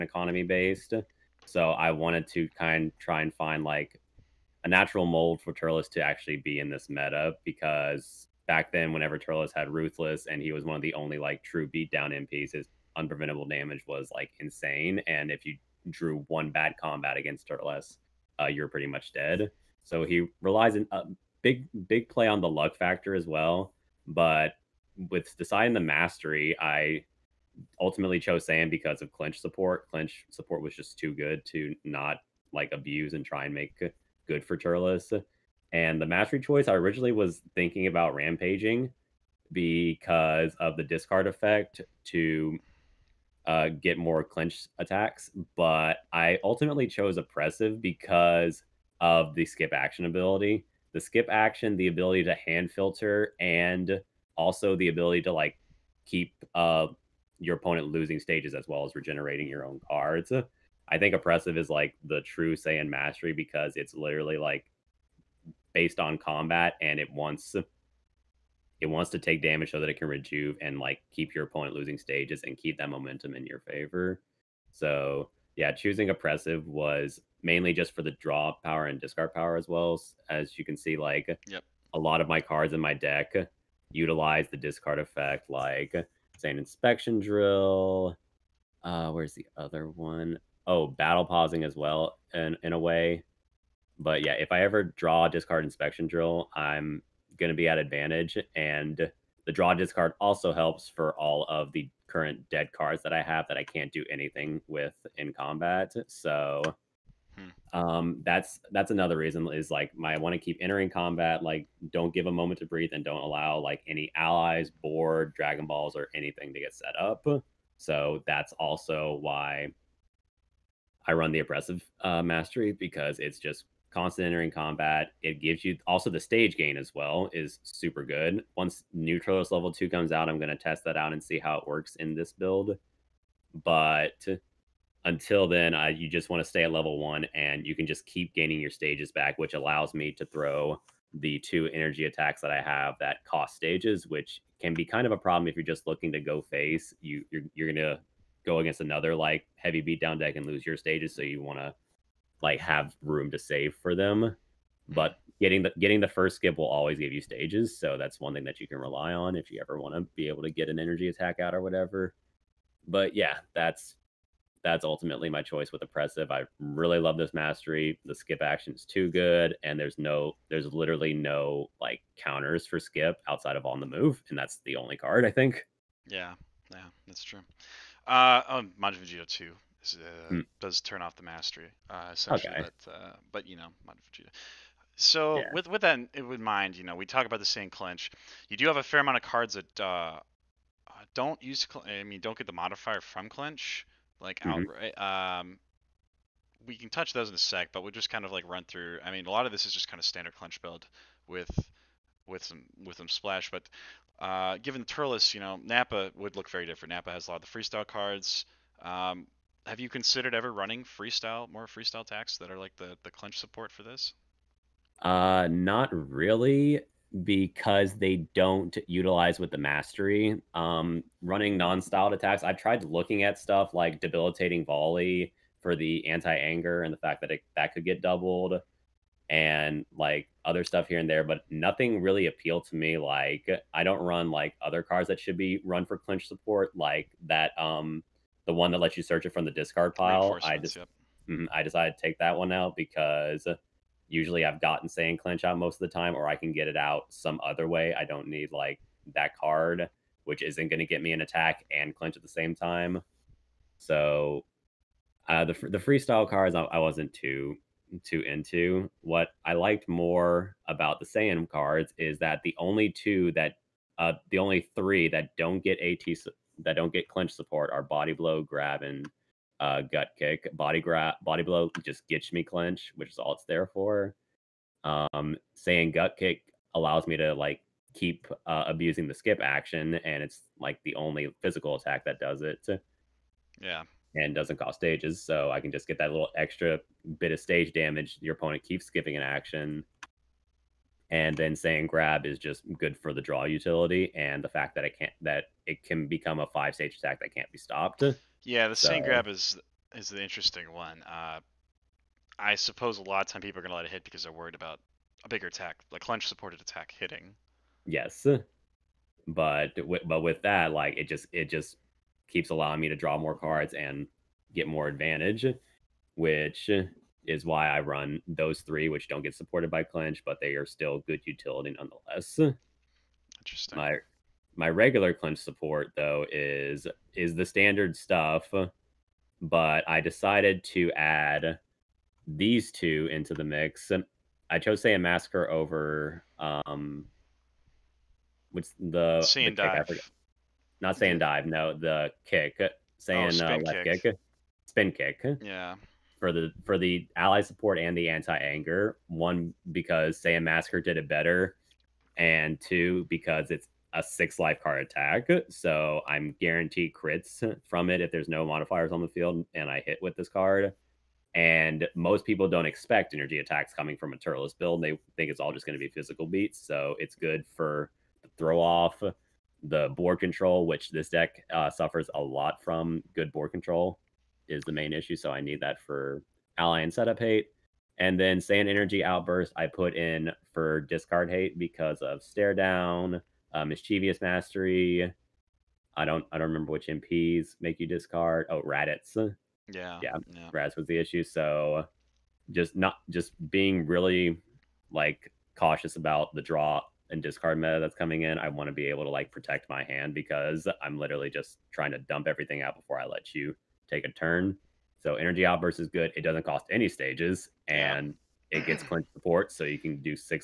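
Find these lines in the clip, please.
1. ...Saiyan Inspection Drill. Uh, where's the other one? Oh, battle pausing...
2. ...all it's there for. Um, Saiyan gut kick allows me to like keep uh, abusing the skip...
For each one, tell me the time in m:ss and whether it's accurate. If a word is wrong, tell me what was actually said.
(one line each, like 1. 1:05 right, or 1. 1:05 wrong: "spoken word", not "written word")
1. 1:26 right
2. 4:33 right.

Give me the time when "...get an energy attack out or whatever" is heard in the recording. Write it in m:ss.
2:40.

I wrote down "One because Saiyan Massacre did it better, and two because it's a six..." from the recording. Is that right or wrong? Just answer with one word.
right.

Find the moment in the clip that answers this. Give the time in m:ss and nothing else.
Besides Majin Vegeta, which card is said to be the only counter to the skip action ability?
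2:53.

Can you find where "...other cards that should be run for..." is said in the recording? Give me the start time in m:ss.
3:54.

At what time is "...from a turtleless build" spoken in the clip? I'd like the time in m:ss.
6:03.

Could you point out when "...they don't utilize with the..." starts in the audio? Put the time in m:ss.
3:37.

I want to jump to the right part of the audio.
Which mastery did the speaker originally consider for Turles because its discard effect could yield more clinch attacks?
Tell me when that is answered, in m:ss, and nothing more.
0:38.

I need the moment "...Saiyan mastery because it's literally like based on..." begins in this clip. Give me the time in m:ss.
1:02.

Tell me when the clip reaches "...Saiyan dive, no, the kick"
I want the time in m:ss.
5:40.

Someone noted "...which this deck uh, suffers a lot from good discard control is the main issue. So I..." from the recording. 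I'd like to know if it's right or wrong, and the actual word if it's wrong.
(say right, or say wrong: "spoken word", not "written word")
wrong: "board", not "discard".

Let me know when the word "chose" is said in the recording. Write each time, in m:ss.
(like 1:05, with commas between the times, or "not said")
0:28, 0:46, 5:34.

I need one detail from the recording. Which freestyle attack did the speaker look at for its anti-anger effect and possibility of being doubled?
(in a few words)
Debilitating volley.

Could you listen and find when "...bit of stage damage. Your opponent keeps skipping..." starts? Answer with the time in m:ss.
4:47.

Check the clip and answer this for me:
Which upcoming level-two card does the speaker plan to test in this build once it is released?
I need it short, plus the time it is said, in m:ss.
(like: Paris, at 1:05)
Neutralist, at 2:08.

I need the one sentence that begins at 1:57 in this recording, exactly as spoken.
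So that's also why I run the oppressive uh, mastery because it's just constant entering combat.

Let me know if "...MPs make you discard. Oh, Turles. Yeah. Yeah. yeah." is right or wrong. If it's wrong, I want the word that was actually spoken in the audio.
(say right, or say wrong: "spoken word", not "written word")
wrong: "Raditz", not "Turles".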